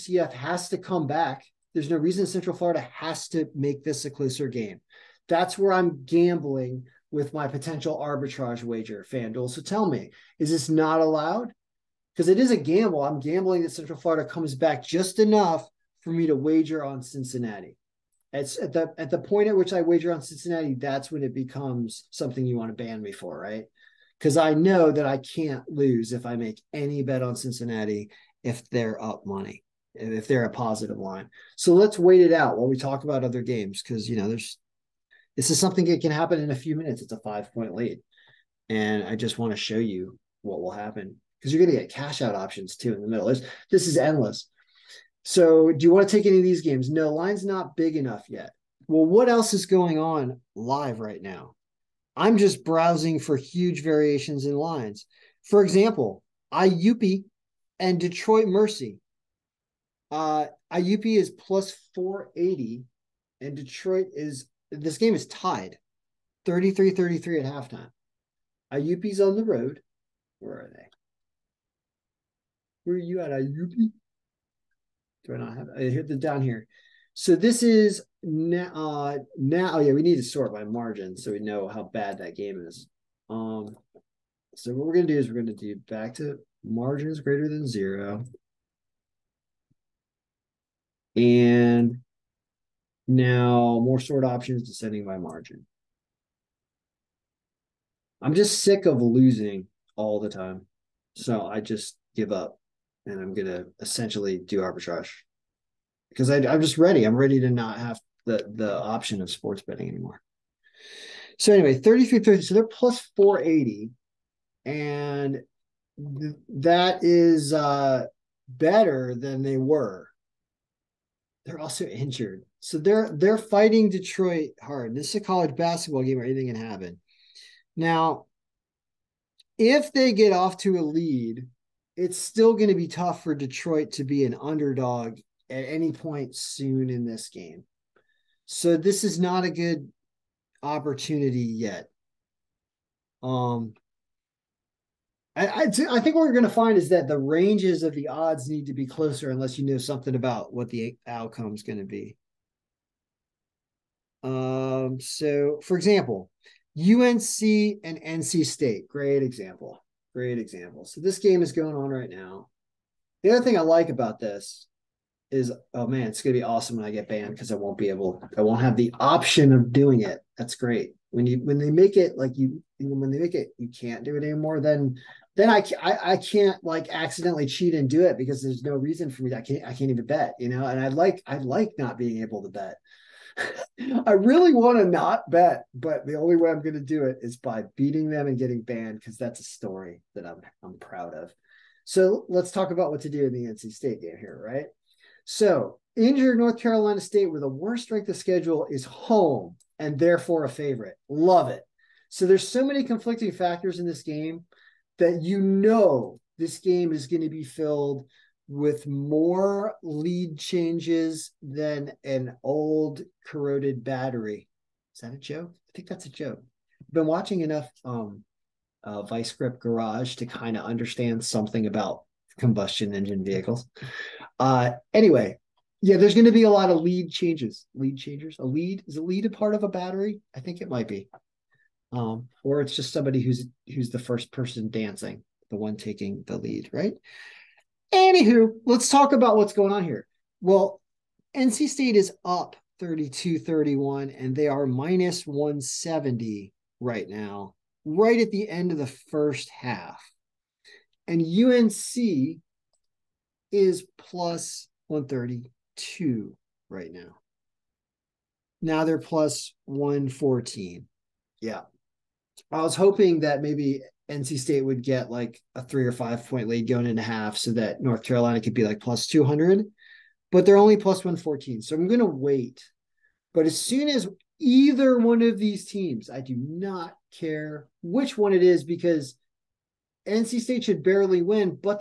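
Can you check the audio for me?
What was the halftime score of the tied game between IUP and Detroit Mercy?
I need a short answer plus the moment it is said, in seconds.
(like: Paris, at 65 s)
33-33, at 66 s.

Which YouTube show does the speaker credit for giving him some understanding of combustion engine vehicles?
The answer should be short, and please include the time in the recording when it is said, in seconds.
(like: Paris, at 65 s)
Vice Grip Garage, at 219 s.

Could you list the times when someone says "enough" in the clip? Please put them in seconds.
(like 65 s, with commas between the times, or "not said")
15 s, 47 s, 217 s.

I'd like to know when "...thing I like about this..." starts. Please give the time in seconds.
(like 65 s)
163 s.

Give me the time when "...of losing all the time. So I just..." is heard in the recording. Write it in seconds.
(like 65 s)
98 s.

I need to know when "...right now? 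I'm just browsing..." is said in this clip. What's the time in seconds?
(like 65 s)
50 s.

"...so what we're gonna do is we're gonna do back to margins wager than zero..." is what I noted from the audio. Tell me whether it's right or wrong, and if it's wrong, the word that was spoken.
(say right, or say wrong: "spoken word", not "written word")
wrong: "greater", not "wager".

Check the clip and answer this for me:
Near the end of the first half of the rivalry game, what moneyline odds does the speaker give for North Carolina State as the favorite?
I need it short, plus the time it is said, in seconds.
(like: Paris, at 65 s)
-170, at 244 s.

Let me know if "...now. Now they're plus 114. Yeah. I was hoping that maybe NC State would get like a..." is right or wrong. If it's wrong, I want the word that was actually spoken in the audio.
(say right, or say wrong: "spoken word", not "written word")
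right.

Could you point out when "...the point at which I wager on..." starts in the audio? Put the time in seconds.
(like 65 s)
19 s.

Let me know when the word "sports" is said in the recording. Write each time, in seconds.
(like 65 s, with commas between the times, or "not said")
109 s.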